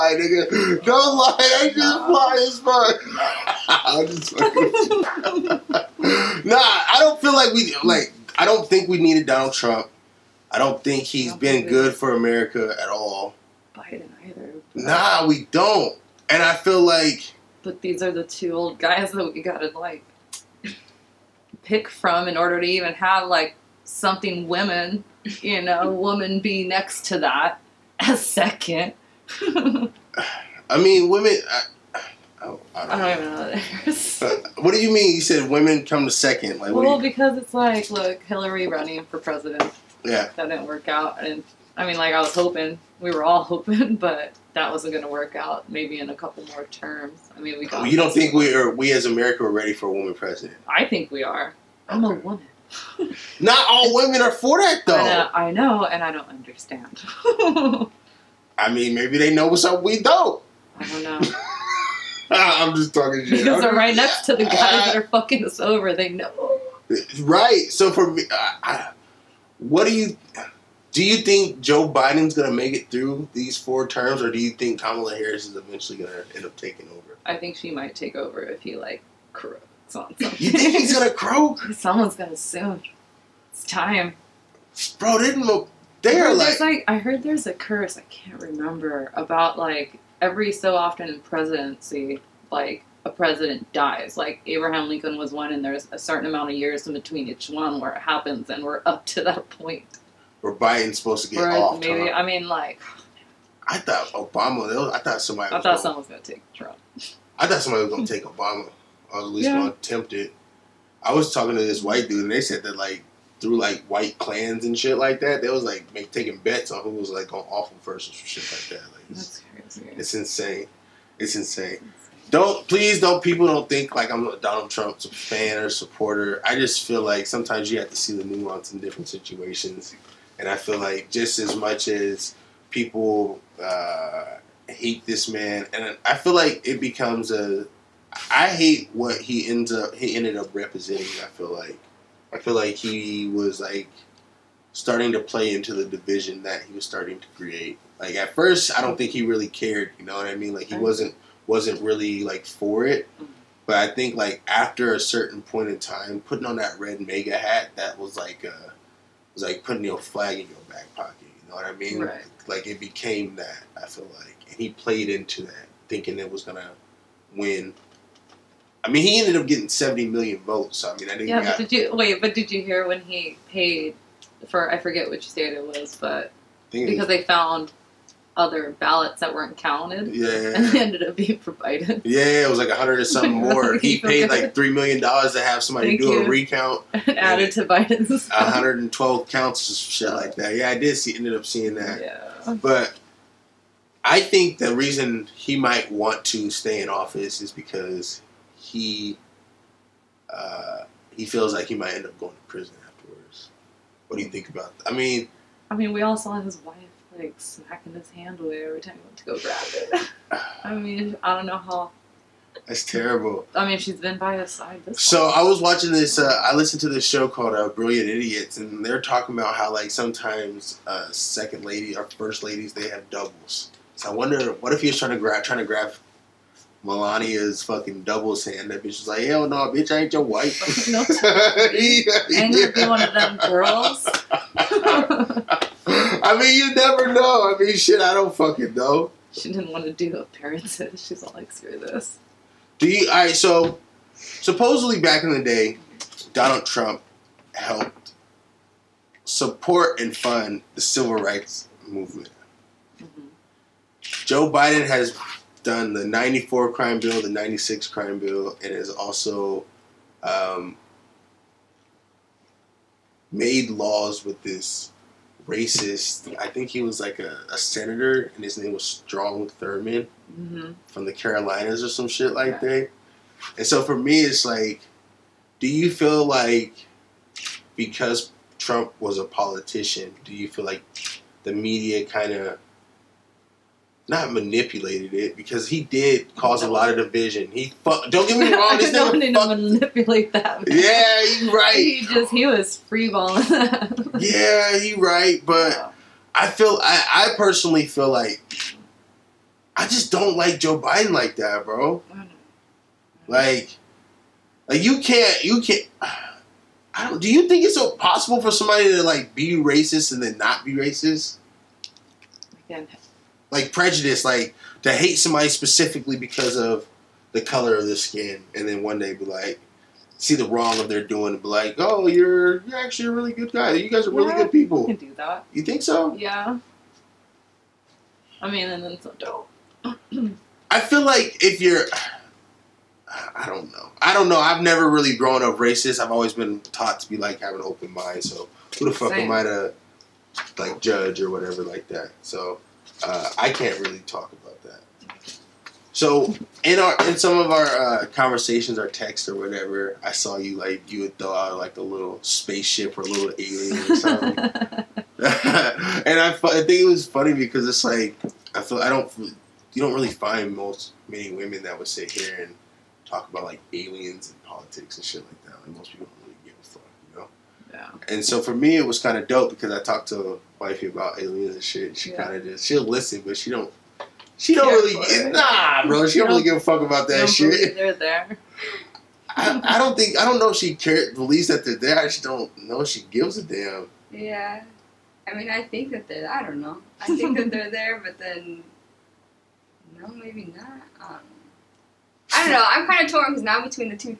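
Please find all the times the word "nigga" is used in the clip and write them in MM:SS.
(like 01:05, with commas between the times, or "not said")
00:00, 04:49.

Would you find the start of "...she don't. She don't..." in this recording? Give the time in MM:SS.
06:13.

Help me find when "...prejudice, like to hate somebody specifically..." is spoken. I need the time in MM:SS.
05:13.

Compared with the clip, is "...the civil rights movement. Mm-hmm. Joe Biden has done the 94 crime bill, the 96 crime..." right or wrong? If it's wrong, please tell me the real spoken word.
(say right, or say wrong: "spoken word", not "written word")
right.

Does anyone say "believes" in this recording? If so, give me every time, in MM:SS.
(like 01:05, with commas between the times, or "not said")
06:21.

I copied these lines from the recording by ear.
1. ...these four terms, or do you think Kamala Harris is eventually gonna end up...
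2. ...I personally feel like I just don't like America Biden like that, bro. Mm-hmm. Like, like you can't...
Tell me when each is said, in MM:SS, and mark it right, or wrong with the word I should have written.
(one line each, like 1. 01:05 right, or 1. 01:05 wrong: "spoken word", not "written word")
1. 01:13 right
2. 04:57 wrong: "Joe", not "America".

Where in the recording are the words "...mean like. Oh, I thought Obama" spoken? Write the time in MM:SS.
01:42.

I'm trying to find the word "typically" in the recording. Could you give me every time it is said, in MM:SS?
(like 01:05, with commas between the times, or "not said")
not said.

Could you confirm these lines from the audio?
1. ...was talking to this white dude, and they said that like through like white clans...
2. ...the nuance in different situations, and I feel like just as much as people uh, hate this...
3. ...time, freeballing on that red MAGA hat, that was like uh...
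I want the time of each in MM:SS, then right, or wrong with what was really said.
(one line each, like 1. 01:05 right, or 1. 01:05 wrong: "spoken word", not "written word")
1. 01:51 right
2. 02:08 right
3. 02:35 wrong: "putting", not "freeballing".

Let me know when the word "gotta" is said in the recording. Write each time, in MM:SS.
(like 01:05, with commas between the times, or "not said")
00:19.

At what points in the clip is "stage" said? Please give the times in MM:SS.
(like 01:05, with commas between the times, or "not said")
not said.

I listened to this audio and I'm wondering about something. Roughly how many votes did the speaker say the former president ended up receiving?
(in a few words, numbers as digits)
70 million.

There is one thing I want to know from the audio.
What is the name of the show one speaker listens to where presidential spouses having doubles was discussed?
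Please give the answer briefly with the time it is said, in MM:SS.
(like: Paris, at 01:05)
Brilliant Idiots, at 03:37.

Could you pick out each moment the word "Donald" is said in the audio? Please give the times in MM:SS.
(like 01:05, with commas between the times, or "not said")
00:09, 02:04, 04:06.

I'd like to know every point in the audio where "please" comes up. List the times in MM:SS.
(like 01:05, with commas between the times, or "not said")
02:02.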